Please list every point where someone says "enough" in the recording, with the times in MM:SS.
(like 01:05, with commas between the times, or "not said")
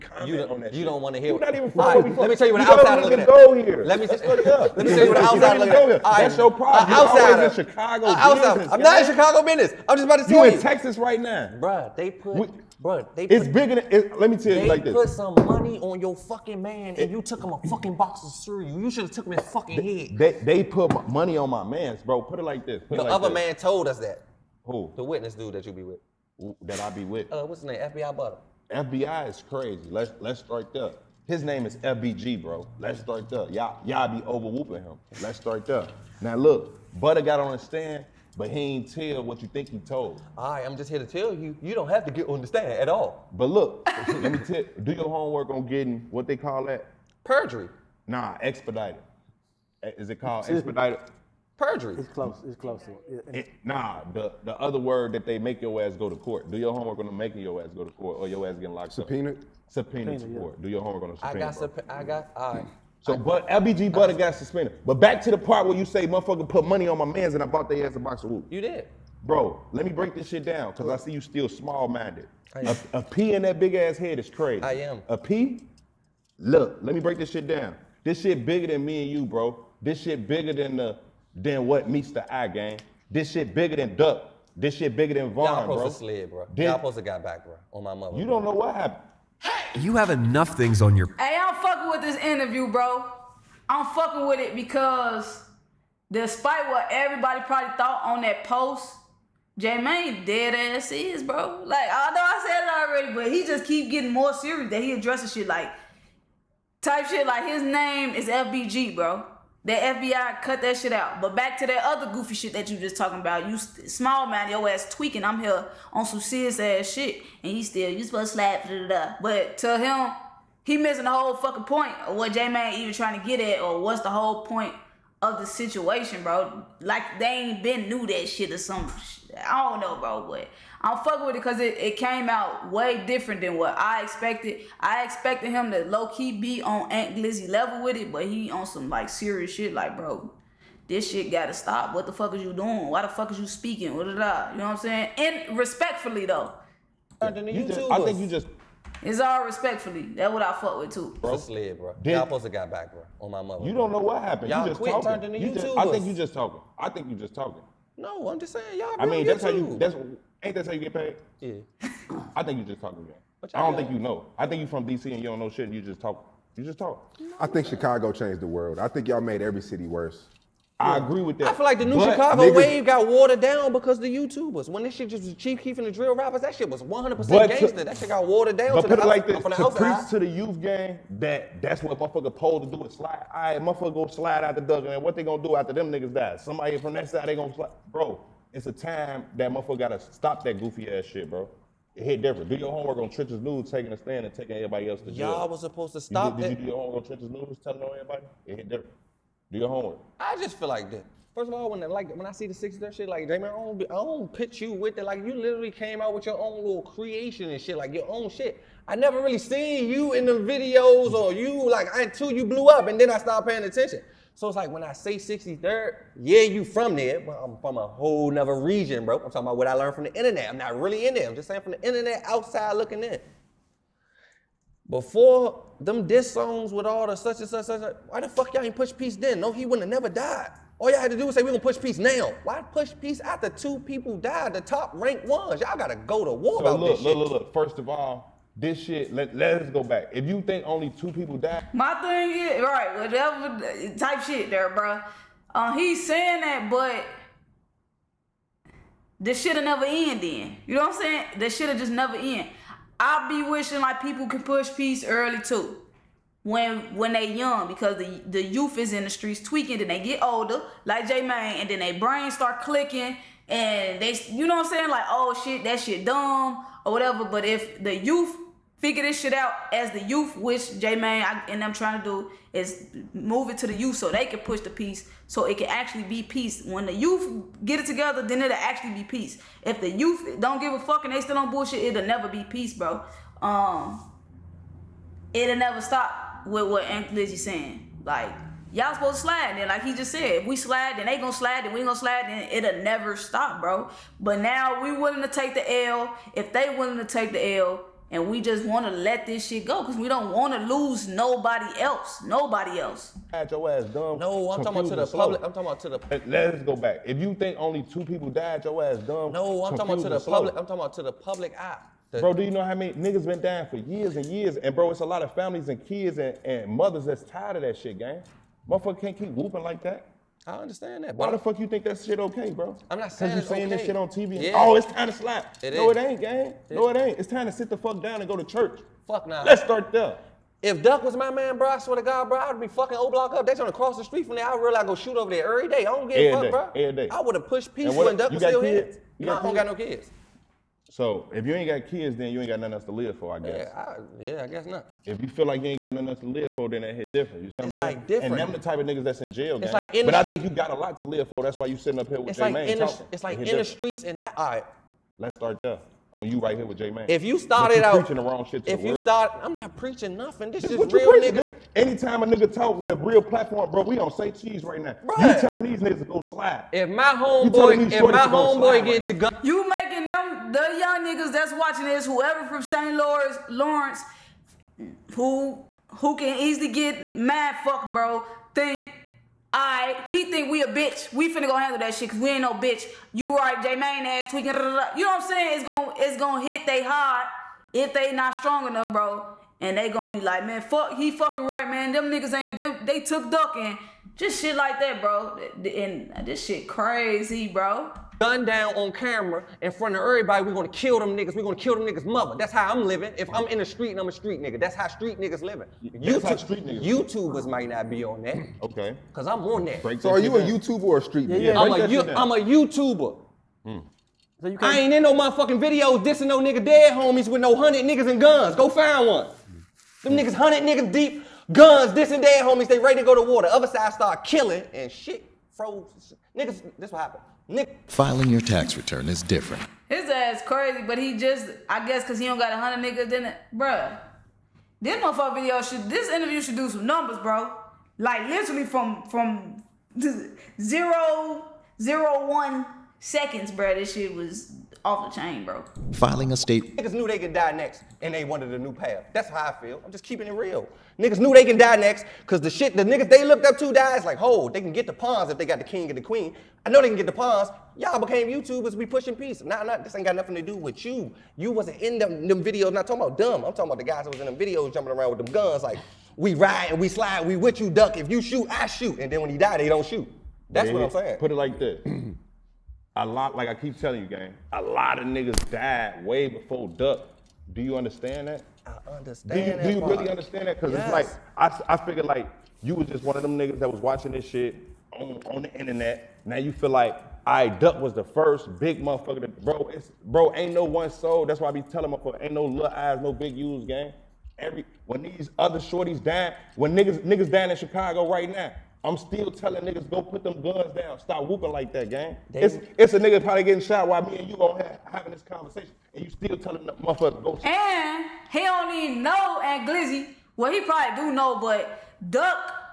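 01:30, 06:28.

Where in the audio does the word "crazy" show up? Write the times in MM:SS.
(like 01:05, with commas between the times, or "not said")
00:29, 01:14, 06:36, 07:10.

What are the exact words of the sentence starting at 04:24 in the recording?
Like oh shit, that shit dumb or whatever.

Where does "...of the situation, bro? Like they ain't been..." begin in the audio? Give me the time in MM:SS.
02:05.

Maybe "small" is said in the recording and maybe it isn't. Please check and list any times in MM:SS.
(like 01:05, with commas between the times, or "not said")
01:11, 01:53.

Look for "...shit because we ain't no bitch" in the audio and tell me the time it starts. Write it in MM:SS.
06:21.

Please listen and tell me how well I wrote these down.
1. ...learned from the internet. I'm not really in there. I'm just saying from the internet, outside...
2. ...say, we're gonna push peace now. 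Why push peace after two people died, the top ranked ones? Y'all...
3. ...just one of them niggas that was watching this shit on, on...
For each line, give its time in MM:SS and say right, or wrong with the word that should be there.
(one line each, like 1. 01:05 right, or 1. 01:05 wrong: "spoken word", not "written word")
1. 03:39 right
2. 03:51 right
3. 08:02 right.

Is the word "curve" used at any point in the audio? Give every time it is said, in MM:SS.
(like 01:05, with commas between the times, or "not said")
not said.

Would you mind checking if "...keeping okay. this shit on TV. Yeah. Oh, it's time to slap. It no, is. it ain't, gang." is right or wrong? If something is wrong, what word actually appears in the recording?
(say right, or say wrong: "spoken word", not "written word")
wrong: "saying", not "keeping".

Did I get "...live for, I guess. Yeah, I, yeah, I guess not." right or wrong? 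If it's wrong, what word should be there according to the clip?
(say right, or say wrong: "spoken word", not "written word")
right.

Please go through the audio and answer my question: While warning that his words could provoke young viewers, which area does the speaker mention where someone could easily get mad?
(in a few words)
St. Lawrence.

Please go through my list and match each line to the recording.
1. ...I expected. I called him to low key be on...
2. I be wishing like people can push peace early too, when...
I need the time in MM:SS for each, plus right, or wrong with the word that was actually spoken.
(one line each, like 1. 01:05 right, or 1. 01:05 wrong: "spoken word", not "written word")
1. 02:13 wrong: "expected", not "called"
2. 04:12 right.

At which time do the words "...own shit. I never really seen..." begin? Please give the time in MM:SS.
03:28.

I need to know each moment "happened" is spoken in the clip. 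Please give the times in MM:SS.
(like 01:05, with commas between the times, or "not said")
01:28, 02:34, 07:07.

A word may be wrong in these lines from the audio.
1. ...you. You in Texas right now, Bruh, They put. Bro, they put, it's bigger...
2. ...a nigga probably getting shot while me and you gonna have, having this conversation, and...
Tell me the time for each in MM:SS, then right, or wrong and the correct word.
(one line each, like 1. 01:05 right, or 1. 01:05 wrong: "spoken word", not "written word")
1. 00:10 right
2. 08:22 right.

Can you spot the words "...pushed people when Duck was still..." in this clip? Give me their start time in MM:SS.
05:37.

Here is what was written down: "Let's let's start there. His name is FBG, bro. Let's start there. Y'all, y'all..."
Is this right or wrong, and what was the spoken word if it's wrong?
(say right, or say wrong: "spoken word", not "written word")
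right.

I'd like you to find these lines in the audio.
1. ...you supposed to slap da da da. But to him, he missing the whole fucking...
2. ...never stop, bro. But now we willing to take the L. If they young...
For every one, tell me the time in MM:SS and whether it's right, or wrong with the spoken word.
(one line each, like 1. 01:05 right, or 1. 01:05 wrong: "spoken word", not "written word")
1. 01:57 right
2. 04:52 wrong: "willing", not "young".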